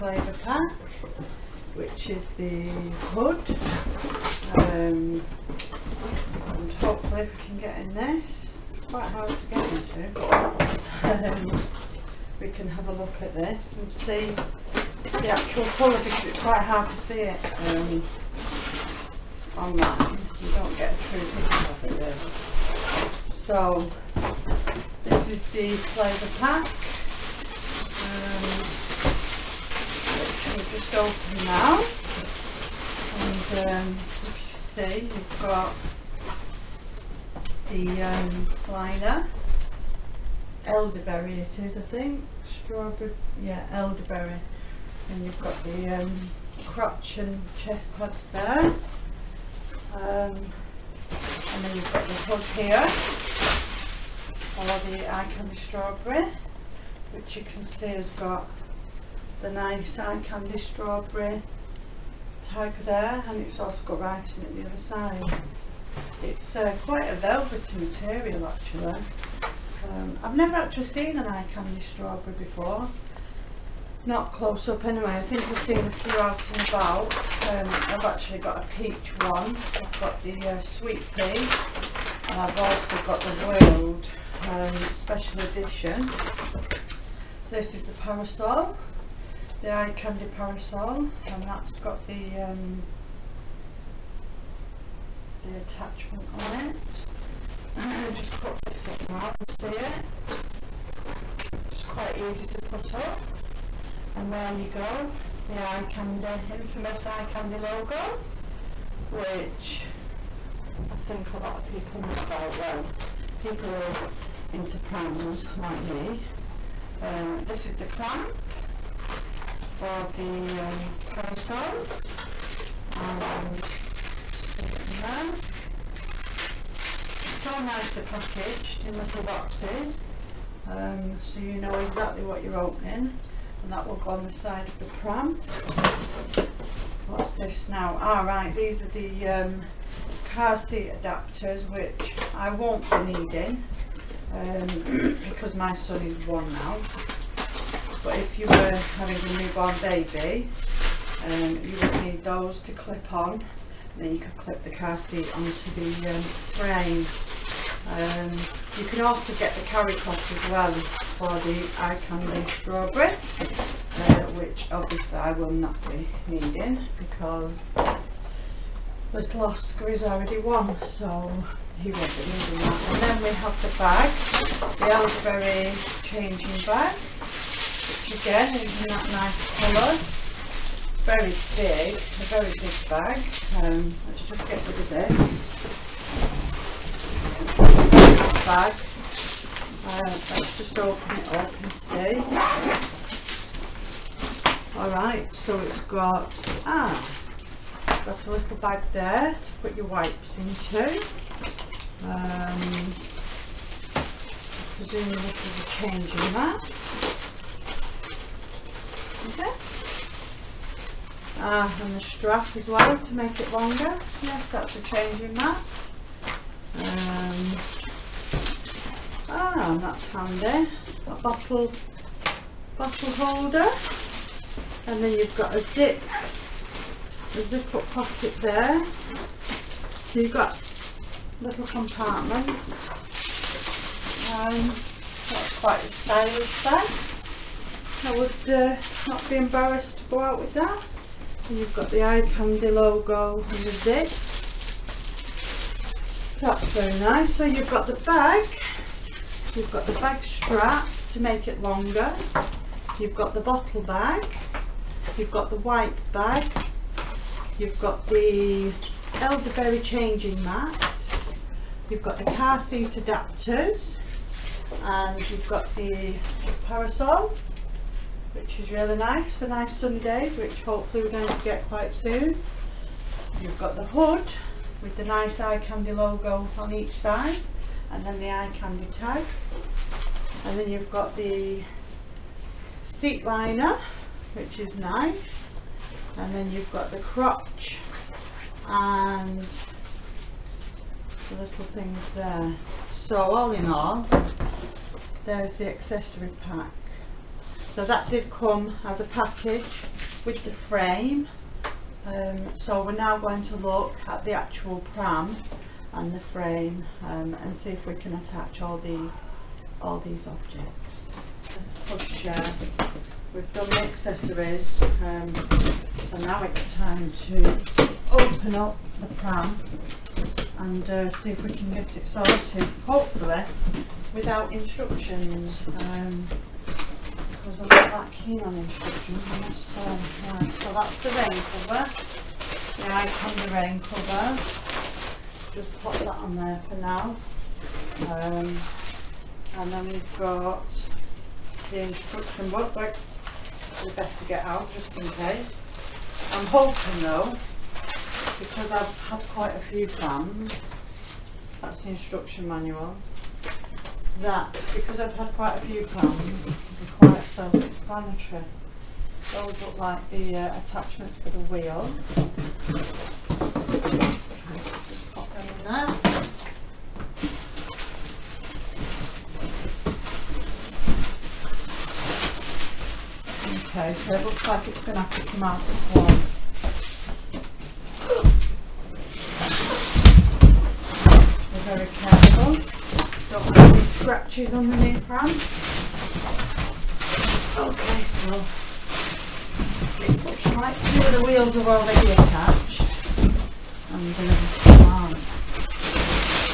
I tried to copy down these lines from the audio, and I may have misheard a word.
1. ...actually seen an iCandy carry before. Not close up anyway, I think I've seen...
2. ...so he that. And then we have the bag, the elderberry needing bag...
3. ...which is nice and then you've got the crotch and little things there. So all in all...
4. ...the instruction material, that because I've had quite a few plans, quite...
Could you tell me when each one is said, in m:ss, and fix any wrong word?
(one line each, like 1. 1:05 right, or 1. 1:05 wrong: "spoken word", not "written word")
1. 1:10 wrong: "strawberry", not "carry"
2. 2:50 wrong: "changing", not "needing"
3. 4:44 right
4. 5:51 wrong: "manual", not "material".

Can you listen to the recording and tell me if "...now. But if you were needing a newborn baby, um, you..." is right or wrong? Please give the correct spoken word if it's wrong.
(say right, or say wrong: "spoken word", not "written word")
wrong: "having", not "needing".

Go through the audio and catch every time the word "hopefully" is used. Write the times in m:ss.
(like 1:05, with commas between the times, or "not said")
0:06, 4:30, 5:22.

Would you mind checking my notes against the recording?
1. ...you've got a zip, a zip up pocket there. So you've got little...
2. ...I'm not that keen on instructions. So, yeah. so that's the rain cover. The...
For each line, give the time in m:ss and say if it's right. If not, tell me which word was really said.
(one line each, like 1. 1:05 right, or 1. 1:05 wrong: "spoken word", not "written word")
1. 3:45 right
2. 5:27 right.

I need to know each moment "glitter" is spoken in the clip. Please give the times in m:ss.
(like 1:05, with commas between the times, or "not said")
not said.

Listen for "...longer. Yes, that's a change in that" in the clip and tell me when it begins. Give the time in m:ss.
3:33.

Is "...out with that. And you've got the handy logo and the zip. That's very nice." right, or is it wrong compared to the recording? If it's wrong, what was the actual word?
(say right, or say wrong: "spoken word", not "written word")
wrong: "iCandy", not "handy".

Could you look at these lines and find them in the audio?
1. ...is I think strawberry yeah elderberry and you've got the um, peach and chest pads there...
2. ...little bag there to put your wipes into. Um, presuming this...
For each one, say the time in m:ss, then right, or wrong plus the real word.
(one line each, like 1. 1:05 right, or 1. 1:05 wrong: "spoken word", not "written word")
1. 0:41 wrong: "crotch", not "peach"
2. 3:18 right.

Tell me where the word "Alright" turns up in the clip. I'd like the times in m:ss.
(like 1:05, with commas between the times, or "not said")
2:17, 3:14.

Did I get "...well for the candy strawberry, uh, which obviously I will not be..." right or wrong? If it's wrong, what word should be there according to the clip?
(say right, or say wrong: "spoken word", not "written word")
wrong: "iCandy", not "candy".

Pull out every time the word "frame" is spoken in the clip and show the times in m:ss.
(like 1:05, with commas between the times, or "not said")
2:36, 5:00, 5:06, 6:25.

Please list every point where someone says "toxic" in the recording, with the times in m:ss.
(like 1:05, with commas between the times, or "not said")
not said.